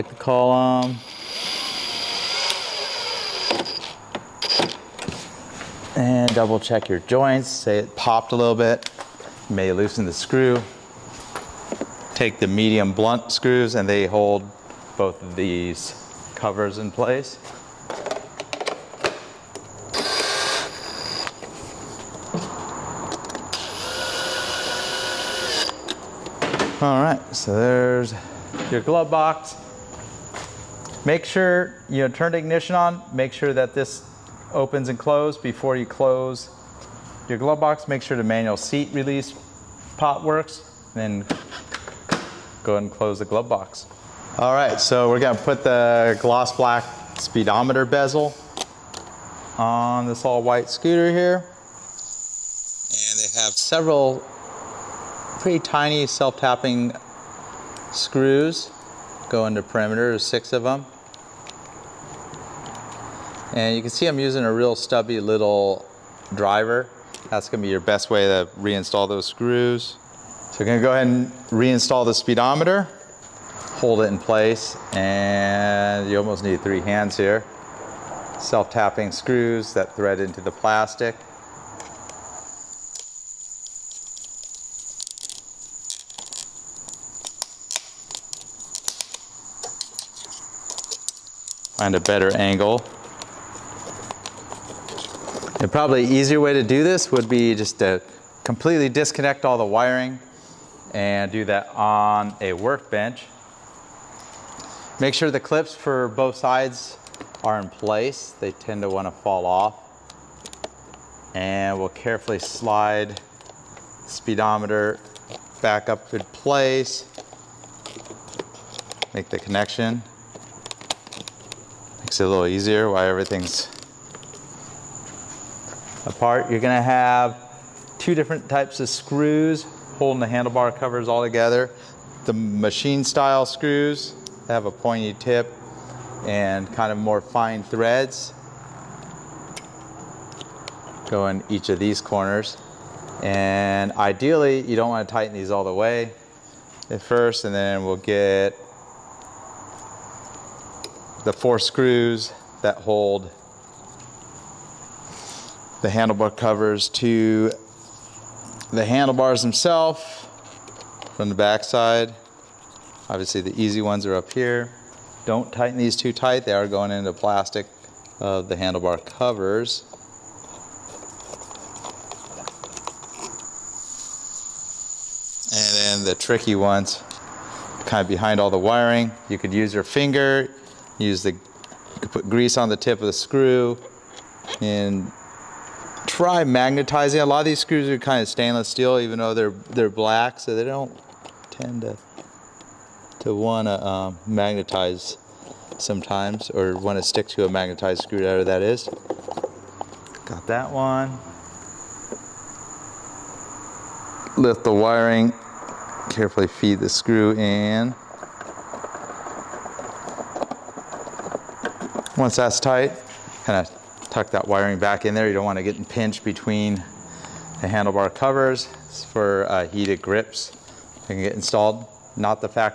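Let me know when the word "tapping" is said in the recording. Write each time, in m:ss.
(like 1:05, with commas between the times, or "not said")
0:56, 1:18.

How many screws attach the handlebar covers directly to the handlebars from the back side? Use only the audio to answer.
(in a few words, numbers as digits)
4.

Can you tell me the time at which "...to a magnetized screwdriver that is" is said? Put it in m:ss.
3:17.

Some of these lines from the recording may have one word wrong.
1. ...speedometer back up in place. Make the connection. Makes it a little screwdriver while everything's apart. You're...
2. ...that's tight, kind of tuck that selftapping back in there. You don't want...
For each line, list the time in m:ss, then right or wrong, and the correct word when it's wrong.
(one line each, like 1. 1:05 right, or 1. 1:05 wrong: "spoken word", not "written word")
1. 1:54 wrong: "easier", not "screwdriver"
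2. 3:32 wrong: "wiring", not "selftapping".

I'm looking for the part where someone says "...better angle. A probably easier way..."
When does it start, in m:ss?
1:31.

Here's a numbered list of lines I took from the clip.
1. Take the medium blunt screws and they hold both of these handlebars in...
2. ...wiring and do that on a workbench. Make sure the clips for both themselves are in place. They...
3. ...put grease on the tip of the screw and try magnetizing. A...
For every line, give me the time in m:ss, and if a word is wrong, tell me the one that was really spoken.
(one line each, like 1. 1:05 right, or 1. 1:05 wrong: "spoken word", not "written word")
1. 0:12 wrong: "covers", not "handlebars"
2. 1:39 wrong: "sides", not "themselves"
3. 3:02 right.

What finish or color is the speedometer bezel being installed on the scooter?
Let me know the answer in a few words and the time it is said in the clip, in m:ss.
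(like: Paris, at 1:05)
gloss black, at 0:46.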